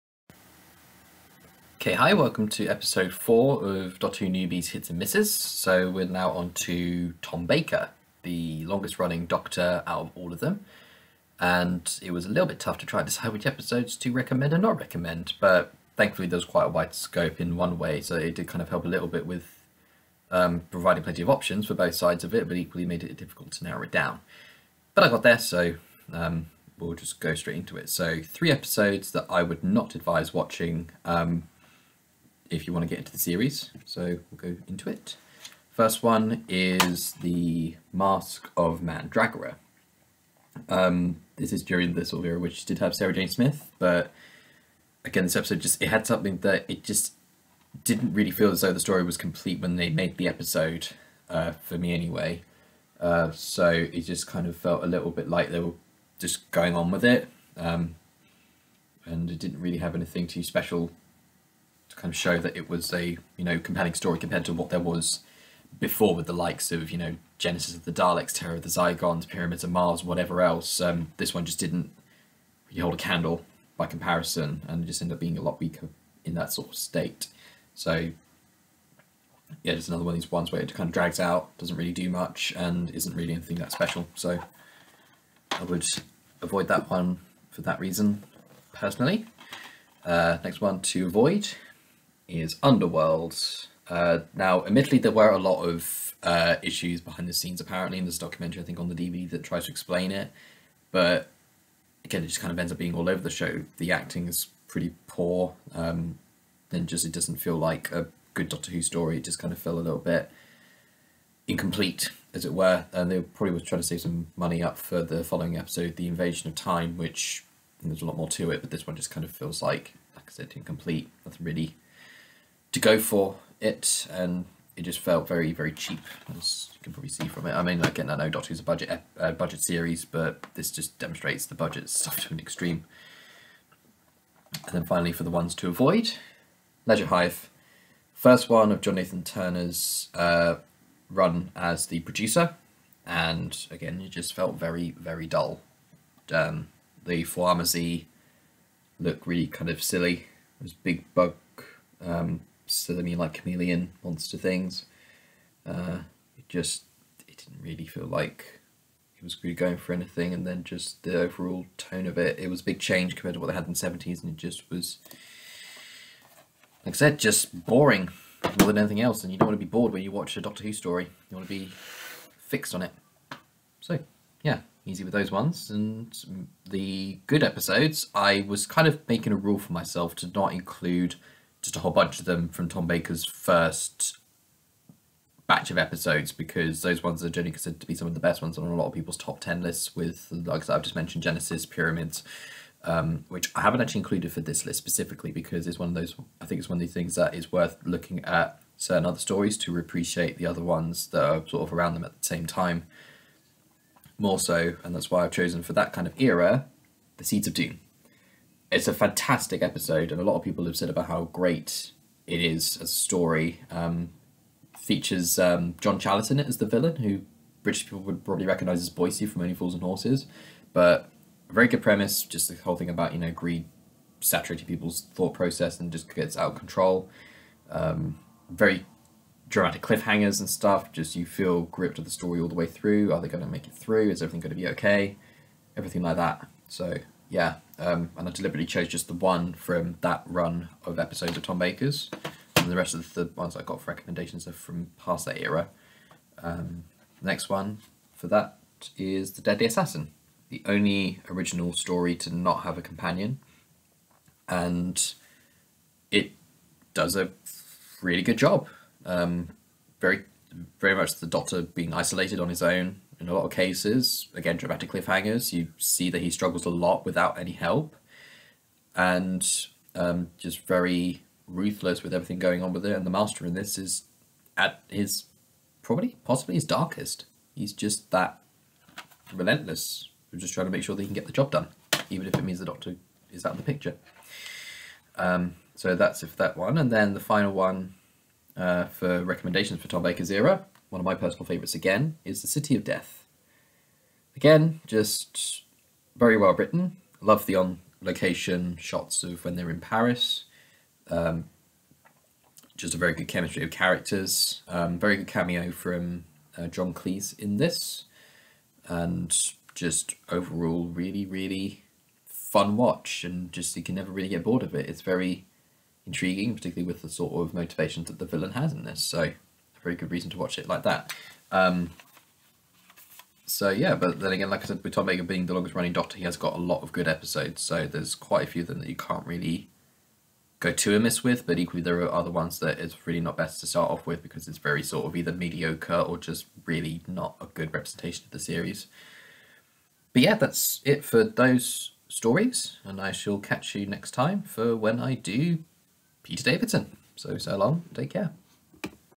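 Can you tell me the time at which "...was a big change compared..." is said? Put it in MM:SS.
02:42.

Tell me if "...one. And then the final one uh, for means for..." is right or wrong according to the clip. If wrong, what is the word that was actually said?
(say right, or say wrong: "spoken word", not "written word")
wrong: "recommendations", not "means".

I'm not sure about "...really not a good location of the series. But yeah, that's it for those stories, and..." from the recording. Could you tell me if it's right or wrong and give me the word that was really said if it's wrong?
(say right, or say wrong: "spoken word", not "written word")
wrong: "representation", not "location".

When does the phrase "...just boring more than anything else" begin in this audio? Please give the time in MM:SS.
02:47.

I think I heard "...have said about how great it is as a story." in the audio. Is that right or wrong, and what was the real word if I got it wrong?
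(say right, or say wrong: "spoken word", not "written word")
right.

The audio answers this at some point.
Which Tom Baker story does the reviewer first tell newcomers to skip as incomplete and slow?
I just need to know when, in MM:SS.
00:37.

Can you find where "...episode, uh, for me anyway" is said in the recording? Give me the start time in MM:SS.
00:50.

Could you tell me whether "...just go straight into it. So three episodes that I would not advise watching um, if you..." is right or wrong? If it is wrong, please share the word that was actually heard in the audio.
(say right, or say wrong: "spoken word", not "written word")
right.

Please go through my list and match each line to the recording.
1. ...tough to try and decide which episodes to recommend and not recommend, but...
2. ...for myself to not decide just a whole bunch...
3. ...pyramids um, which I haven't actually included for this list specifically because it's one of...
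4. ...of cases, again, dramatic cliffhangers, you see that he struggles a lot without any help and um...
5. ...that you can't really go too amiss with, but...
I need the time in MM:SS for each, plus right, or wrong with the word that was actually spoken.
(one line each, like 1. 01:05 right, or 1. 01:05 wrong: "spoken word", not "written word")
1. 00:12 right
2. 02:59 wrong: "include", not "decide"
3. 03:11 right
4. 04:23 right
5. 05:28 right.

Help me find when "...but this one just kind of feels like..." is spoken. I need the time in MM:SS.
01:58.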